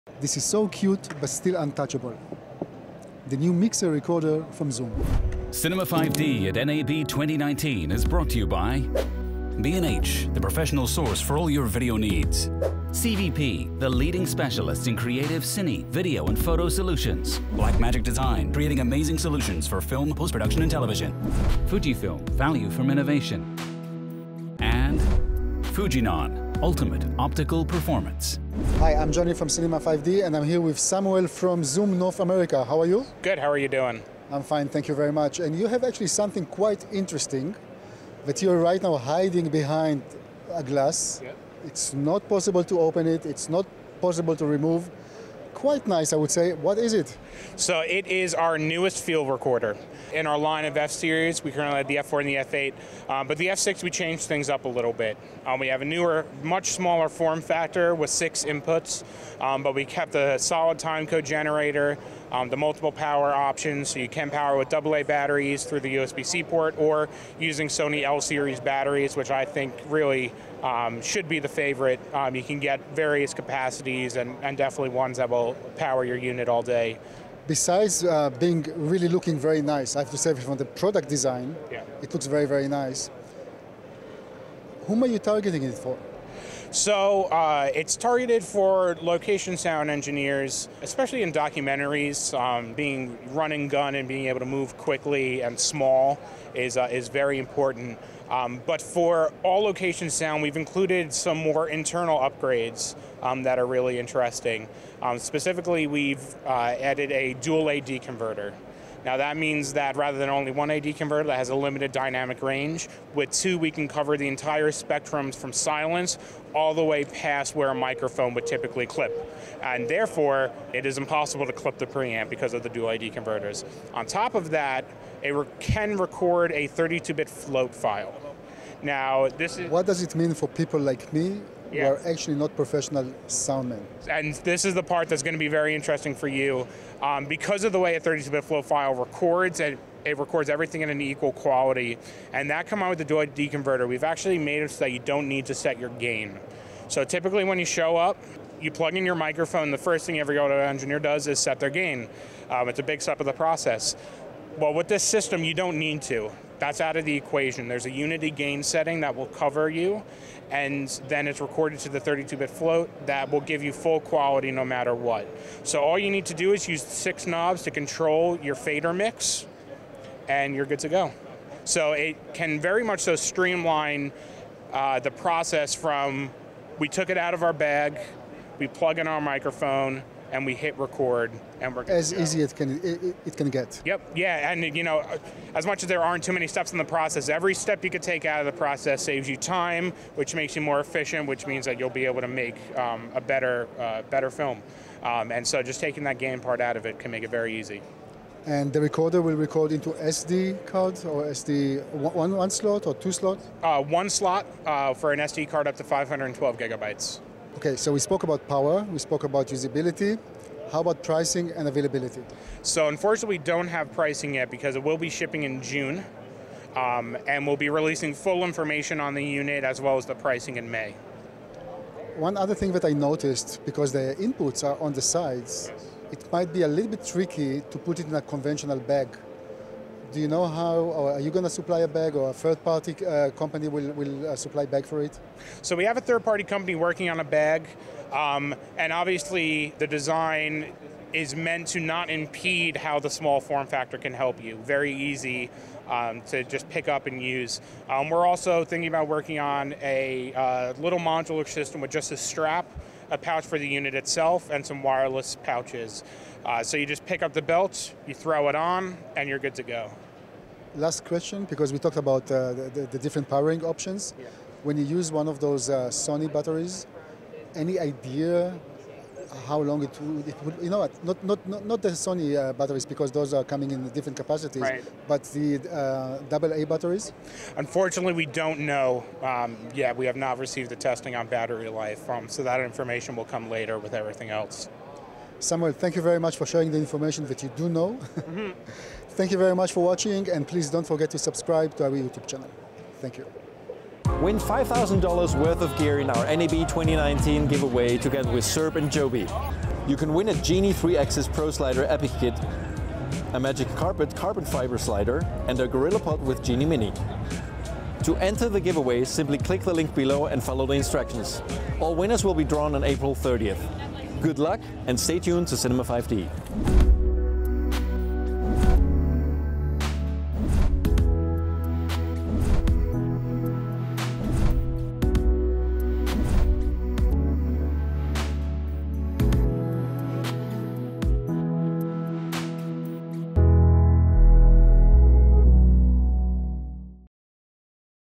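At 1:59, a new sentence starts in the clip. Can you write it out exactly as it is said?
And therefore, it is impossible to clip the preamp because of the dual AD converters.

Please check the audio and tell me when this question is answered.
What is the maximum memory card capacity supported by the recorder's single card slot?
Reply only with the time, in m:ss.
3:25.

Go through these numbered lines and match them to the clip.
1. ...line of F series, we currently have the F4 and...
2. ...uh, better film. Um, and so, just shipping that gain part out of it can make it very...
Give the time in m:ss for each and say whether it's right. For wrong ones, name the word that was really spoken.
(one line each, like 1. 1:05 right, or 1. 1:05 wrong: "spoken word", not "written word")
1. 0:50 right
2. 3:13 wrong: "taking", not "shipping".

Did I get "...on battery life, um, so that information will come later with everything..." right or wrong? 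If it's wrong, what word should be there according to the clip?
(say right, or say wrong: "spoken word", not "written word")
right.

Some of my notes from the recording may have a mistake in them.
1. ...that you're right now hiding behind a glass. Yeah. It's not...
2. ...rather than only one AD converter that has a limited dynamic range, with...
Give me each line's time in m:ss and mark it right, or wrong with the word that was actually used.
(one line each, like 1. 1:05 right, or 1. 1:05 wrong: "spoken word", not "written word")
1. 0:38 right
2. 1:49 right.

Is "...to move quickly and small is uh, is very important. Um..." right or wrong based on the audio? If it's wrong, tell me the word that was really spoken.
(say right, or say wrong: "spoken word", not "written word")
right.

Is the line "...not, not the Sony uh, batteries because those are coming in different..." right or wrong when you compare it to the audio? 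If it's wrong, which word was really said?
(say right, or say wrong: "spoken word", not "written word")
right.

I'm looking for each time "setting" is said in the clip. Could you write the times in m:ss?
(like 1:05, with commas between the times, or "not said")
2:38.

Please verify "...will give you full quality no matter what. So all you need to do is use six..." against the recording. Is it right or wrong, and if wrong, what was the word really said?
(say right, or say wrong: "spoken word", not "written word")
right.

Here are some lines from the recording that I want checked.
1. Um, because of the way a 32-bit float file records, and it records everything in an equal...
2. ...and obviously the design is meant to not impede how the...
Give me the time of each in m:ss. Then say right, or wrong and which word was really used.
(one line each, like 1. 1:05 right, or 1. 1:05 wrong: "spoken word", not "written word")
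1. 2:17 right
2. 3:58 right.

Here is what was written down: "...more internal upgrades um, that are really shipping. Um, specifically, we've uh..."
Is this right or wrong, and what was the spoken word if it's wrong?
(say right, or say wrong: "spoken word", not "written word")
wrong: "interesting", not "shipping".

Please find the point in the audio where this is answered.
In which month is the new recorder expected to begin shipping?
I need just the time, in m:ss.
3:35.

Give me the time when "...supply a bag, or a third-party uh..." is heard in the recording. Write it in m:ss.
3:51.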